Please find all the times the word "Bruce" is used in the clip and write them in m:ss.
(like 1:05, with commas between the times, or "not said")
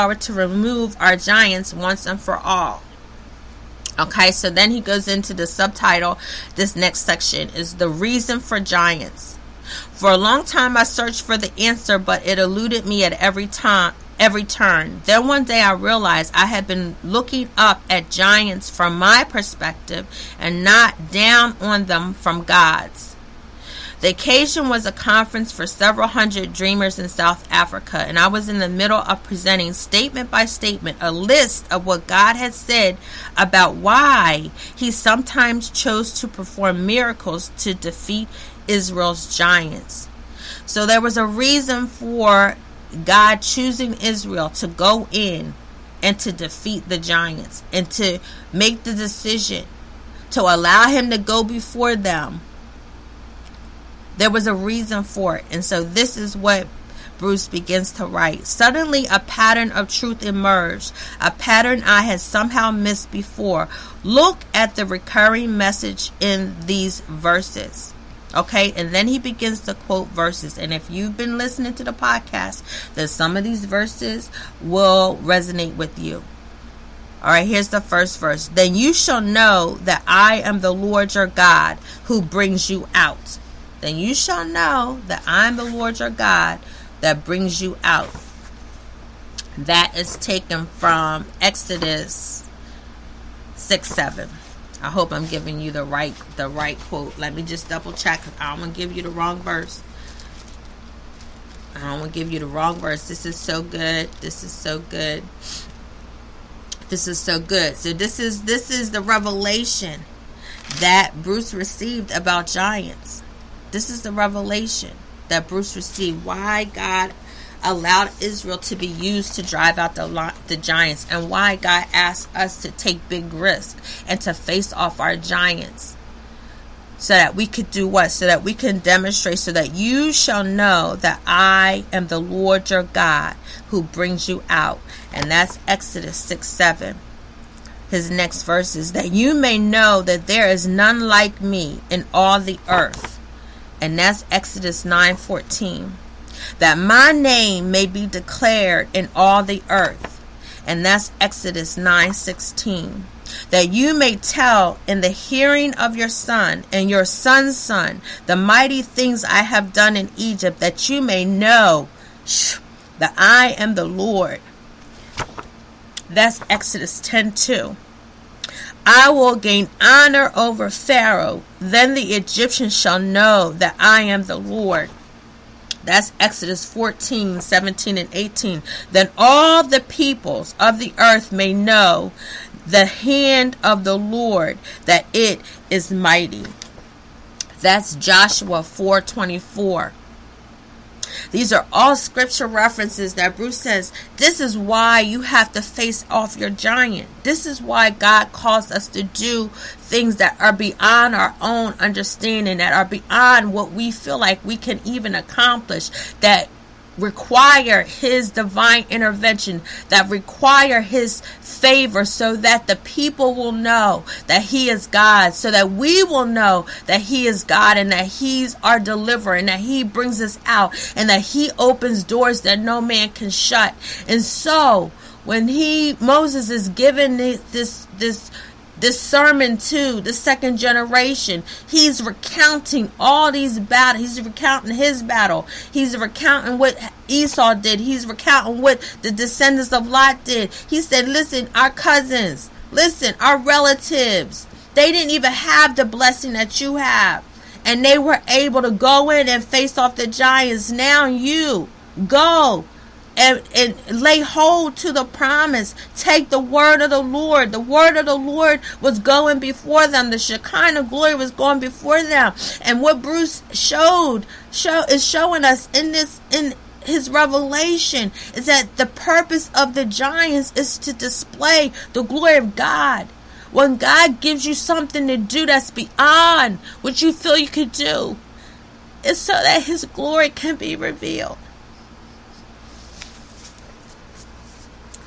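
0:57, 1:51, 1:55, 3:13, 4:23.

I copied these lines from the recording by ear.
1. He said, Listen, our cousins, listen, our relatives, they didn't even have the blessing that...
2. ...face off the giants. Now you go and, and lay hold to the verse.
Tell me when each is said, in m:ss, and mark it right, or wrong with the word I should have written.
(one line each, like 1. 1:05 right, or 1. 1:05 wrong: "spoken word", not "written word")
1. 4:00 right
2. 4:09 wrong: "promise", not "verse".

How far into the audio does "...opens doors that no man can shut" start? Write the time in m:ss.
3:41.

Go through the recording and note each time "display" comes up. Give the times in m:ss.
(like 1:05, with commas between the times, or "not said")
4:30.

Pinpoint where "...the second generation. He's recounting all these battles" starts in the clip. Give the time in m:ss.
3:50.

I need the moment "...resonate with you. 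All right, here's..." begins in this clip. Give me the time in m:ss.
1:15.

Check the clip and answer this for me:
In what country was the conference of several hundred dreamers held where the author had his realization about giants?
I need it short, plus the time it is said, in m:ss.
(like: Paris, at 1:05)
South Africa, at 0:27.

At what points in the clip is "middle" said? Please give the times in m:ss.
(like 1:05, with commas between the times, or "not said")
0:28.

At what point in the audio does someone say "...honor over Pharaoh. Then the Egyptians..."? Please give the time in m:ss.
2:49.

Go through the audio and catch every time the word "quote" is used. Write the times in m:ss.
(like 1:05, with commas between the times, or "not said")
1:09, 1:36.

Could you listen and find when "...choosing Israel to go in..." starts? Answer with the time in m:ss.
0:43.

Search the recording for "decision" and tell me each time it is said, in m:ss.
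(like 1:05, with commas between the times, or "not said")
0:48.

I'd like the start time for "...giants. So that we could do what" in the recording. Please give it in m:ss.
2:05.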